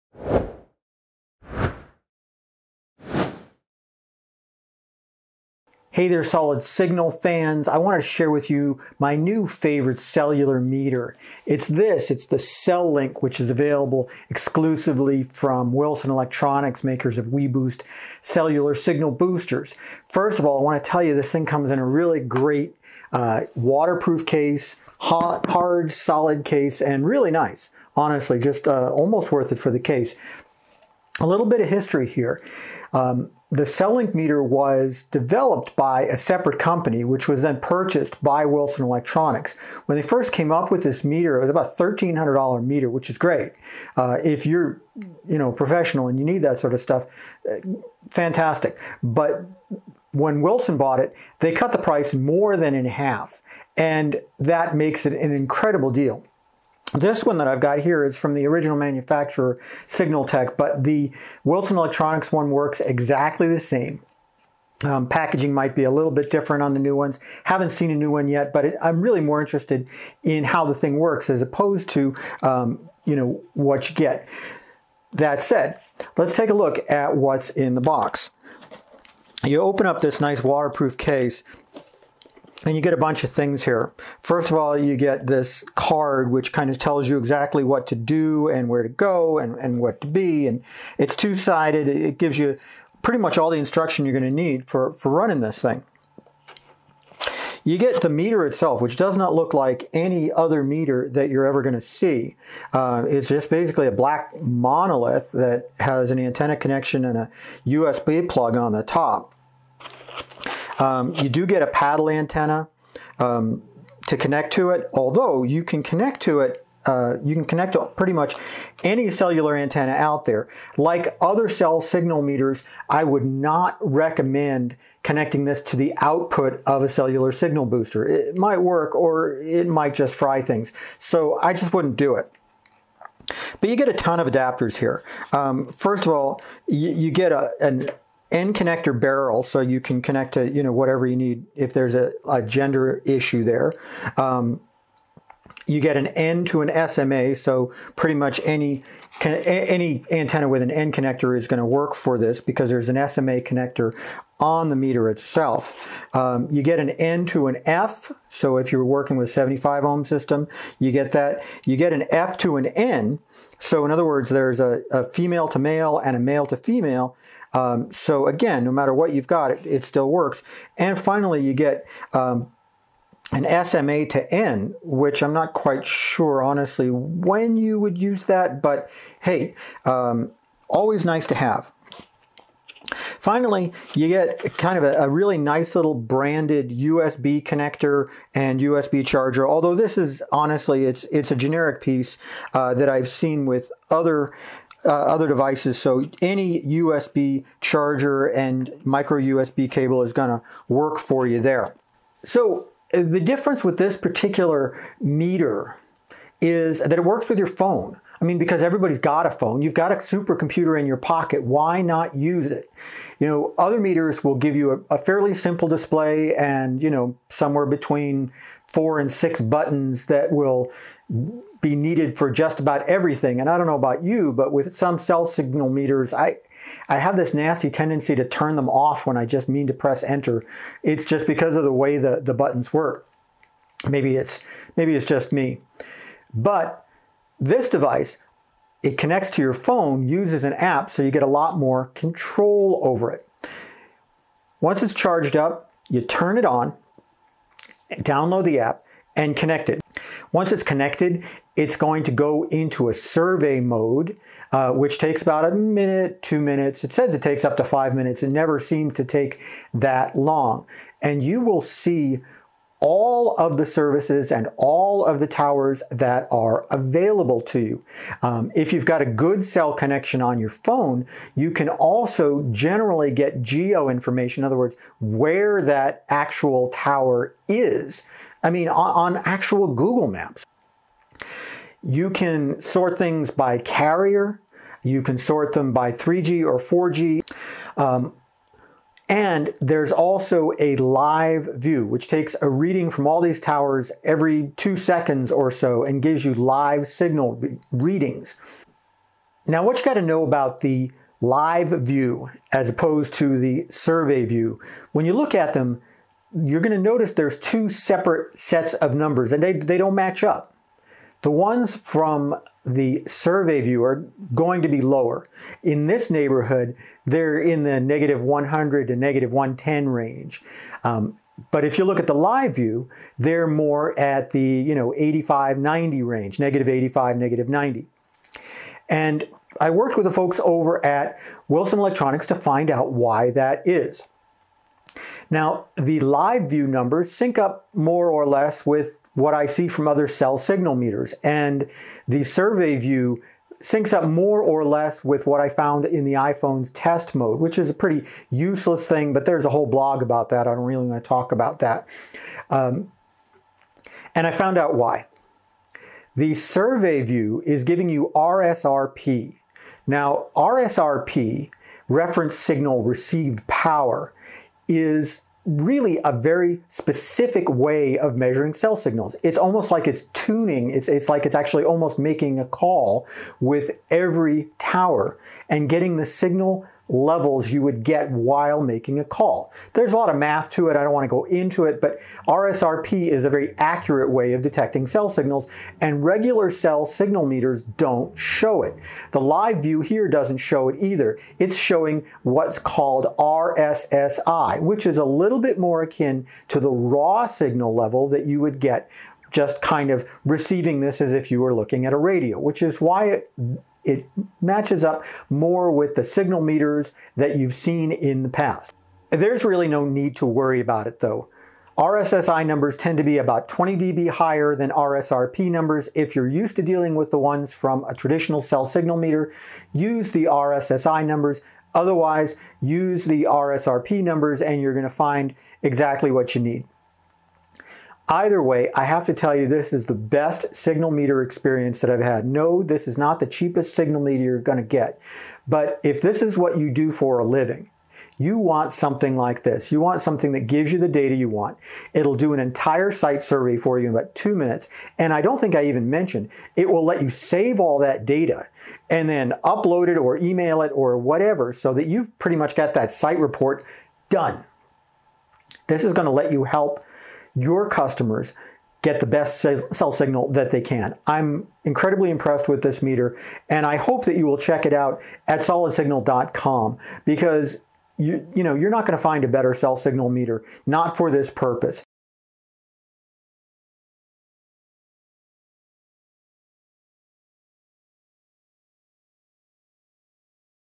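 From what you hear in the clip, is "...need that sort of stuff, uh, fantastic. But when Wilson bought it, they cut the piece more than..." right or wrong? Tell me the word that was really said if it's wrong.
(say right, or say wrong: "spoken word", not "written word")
wrong: "price", not "piece".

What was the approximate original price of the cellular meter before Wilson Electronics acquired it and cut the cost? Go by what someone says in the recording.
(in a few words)
$1,300.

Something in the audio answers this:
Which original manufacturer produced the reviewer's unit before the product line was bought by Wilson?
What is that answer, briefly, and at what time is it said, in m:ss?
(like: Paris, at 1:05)
Signal Tech, at 0:59.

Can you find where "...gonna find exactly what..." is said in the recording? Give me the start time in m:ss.
7:04.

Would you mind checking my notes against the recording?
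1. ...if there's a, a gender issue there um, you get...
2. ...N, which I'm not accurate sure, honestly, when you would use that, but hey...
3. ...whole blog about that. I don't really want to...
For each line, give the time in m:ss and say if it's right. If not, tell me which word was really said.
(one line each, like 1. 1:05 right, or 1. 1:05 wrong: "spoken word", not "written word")
1. 2:21 right
2. 2:54 wrong: "quite", not "accurate"
3. 5:49 right.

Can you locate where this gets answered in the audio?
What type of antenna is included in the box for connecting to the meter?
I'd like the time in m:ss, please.
1:51.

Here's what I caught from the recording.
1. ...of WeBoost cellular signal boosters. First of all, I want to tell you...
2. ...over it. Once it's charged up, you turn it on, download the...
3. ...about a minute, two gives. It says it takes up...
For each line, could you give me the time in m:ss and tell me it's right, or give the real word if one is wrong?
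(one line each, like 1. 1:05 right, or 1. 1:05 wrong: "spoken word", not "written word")
1. 0:17 right
2. 4:02 right
3. 4:15 wrong: "minutes", not "gives".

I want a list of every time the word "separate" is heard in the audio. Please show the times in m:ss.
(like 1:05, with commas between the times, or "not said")
0:36, 5:07.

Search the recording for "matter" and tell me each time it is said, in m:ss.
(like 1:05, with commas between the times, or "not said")
2:48.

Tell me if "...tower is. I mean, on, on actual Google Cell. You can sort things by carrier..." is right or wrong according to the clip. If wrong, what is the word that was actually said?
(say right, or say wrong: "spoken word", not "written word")
wrong: "Maps", not "Cell".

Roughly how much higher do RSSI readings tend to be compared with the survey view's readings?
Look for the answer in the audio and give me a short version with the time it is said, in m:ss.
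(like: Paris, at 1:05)
20 dB, at 6:53.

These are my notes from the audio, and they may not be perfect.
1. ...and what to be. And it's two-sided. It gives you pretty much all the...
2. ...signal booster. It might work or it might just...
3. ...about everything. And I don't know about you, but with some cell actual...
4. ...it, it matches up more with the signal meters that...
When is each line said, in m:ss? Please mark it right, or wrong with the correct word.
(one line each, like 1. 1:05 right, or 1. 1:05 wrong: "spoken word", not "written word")
1. 1:29 right
2. 2:07 right
3. 3:42 wrong: "signal", not "actual"
4. 6:43 right.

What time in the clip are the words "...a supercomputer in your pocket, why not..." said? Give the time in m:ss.
3:29.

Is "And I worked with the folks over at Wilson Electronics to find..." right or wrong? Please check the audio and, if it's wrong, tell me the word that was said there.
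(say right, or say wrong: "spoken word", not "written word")
right.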